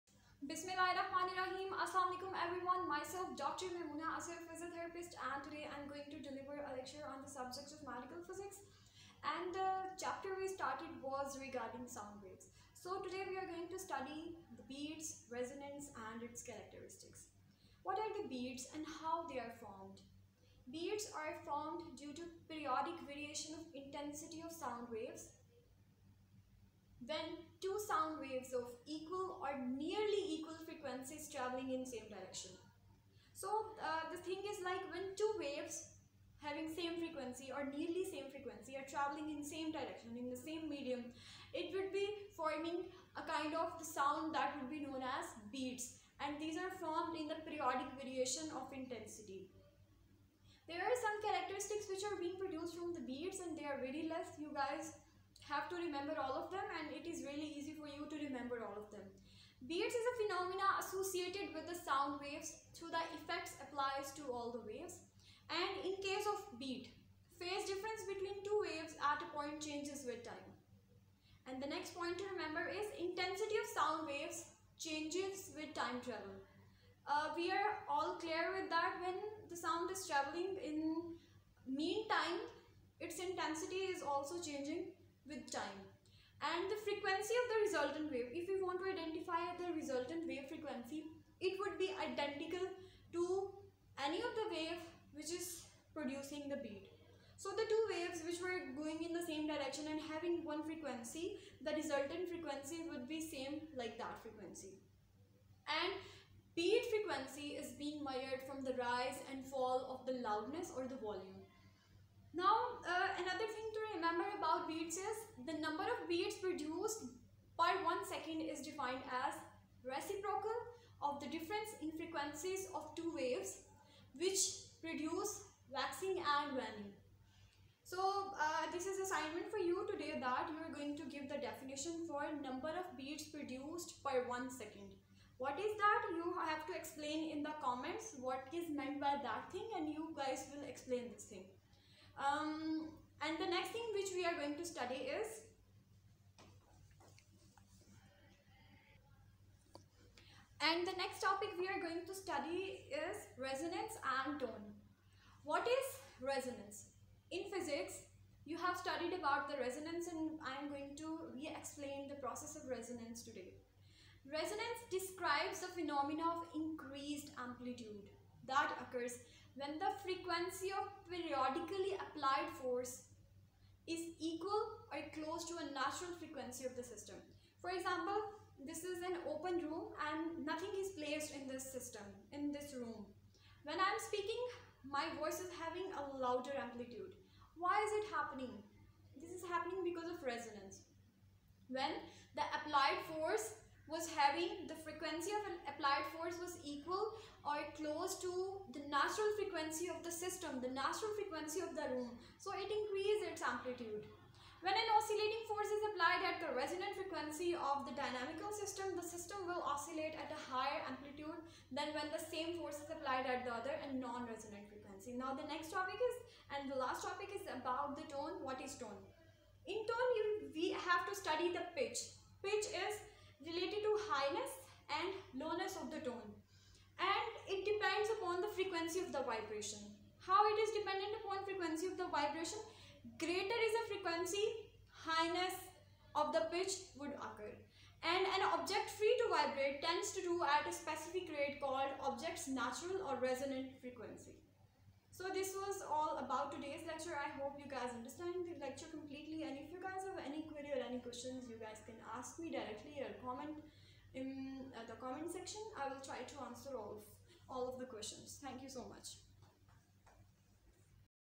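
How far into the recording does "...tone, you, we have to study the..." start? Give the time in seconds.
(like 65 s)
219 s.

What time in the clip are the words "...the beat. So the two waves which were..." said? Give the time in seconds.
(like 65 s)
96 s.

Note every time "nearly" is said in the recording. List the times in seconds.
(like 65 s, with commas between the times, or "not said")
29 s, 37 s.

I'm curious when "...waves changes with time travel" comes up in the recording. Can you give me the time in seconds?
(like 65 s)
74 s.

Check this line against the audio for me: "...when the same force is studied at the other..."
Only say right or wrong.
wrong.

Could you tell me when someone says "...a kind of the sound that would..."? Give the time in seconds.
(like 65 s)
43 s.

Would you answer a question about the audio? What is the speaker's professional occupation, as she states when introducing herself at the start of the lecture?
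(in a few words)
physiotherapist.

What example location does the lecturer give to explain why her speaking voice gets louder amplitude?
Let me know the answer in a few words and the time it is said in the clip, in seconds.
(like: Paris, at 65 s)
an open room, at 179 s.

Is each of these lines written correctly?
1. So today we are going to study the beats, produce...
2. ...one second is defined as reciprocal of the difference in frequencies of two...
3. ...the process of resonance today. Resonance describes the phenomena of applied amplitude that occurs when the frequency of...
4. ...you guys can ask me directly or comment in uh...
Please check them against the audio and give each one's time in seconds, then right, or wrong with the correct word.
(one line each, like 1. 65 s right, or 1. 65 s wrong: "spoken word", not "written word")
1. 12 s wrong: "resonance", not "produce"
2. 117 s right
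3. 162 s wrong: "increased", not "applied"
4. 251 s right.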